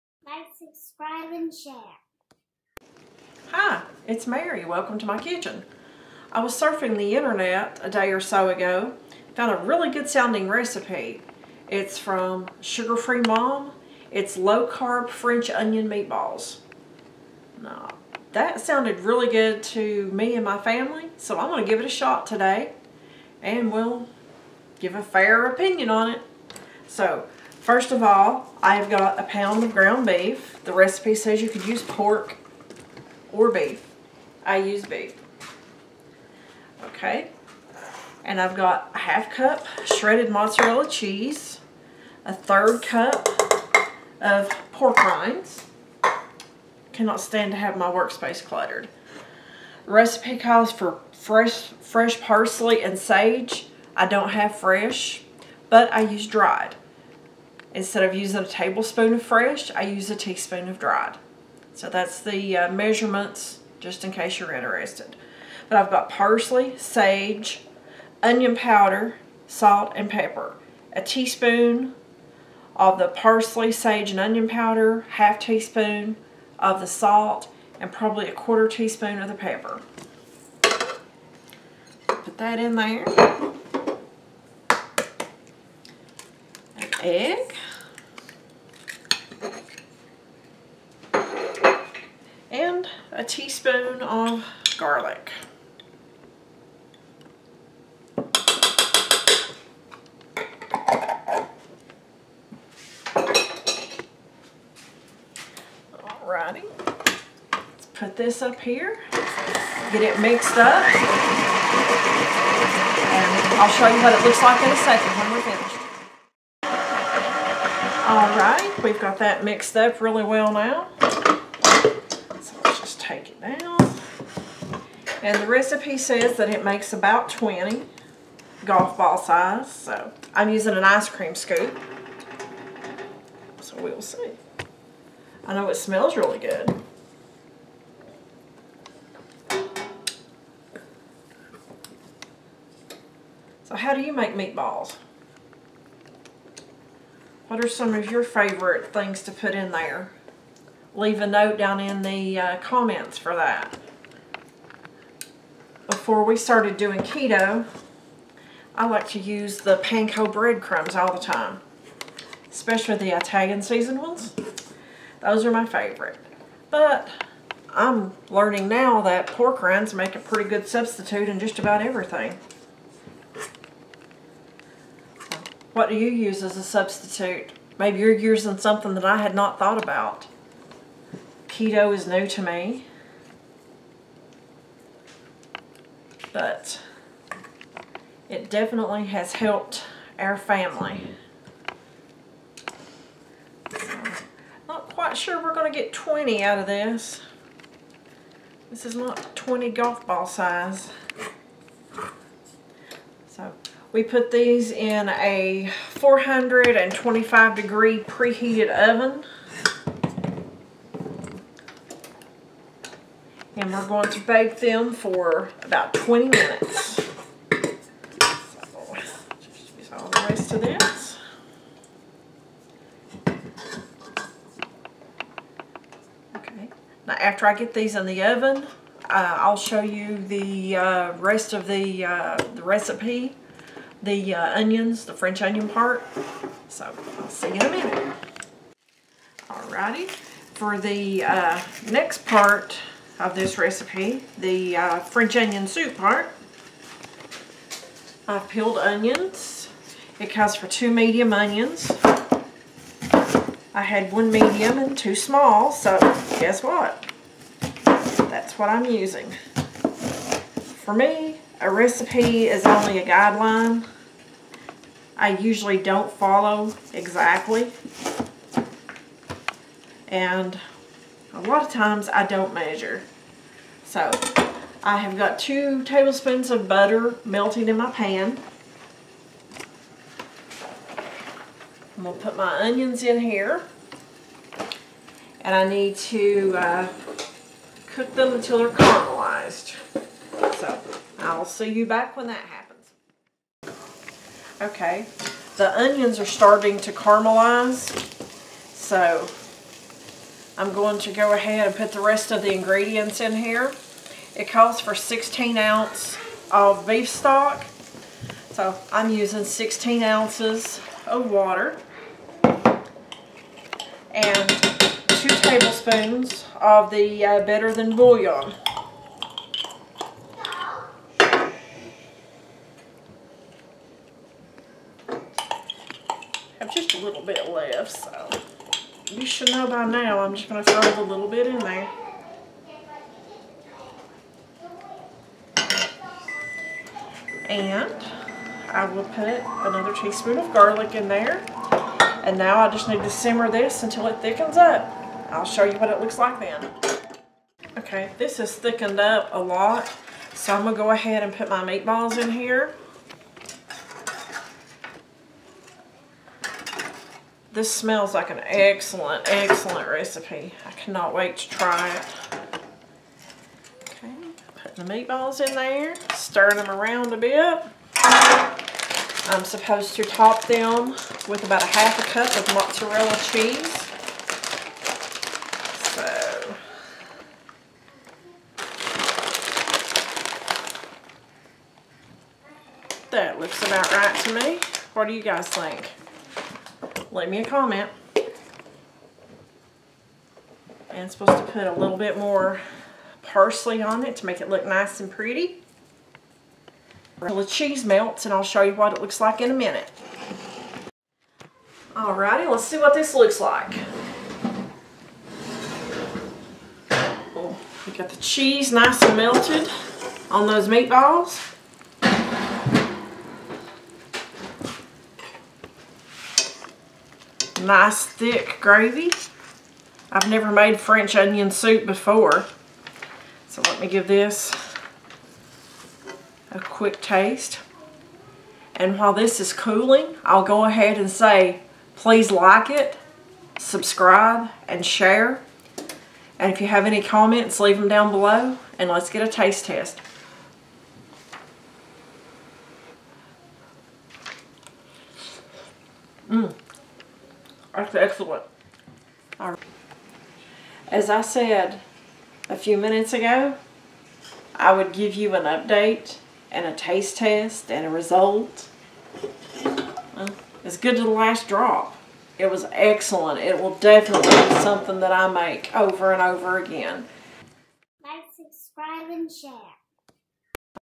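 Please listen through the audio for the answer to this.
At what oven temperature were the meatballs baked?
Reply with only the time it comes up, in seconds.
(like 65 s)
205 s.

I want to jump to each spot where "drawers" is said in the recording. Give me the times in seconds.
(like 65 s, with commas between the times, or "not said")
not said.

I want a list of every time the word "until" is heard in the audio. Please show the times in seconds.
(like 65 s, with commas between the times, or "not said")
288 s, 343 s, 397 s.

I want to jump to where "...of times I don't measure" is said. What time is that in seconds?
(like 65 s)
271 s.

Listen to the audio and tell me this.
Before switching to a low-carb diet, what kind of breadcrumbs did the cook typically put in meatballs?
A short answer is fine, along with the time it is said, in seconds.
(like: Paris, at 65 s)
panko breadcrumbs, at 159 s.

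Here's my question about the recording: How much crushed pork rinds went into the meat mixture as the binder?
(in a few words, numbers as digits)
1/3 cup.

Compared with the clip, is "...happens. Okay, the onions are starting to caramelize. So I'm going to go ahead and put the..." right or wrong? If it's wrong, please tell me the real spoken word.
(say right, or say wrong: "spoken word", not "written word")
right.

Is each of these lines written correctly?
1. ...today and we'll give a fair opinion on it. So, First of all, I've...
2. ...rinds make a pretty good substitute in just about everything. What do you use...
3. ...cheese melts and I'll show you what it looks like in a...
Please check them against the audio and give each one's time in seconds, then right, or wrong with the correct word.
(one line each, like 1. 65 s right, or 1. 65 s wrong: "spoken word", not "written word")
1. 22 s right
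2. 169 s right
3. 397 s right.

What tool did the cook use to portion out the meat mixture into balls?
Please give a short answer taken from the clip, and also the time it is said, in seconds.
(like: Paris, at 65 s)
ice cream scoop, at 130 s.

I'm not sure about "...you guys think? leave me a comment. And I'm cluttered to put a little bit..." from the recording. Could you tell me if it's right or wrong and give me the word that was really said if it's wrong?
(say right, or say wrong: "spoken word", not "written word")
wrong: "supposed", not "cluttered".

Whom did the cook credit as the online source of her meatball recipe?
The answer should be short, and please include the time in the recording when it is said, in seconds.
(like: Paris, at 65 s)
Sugar Free Mom, at 12 s.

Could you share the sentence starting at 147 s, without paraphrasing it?
What are some of your favorite things to put in there?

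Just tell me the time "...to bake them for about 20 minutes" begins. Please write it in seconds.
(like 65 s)
214 s.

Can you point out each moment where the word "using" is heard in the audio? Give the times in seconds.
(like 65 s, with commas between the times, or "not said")
58 s, 130 s, 178 s, 258 s, 309 s.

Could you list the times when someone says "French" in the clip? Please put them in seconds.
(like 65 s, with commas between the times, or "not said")
15 s, 235 s, 244 s, 420 s.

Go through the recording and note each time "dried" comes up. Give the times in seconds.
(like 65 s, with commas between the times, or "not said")
56 s, 60 s.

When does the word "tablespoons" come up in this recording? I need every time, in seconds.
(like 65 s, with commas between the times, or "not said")
58 s, 275 s, 315 s.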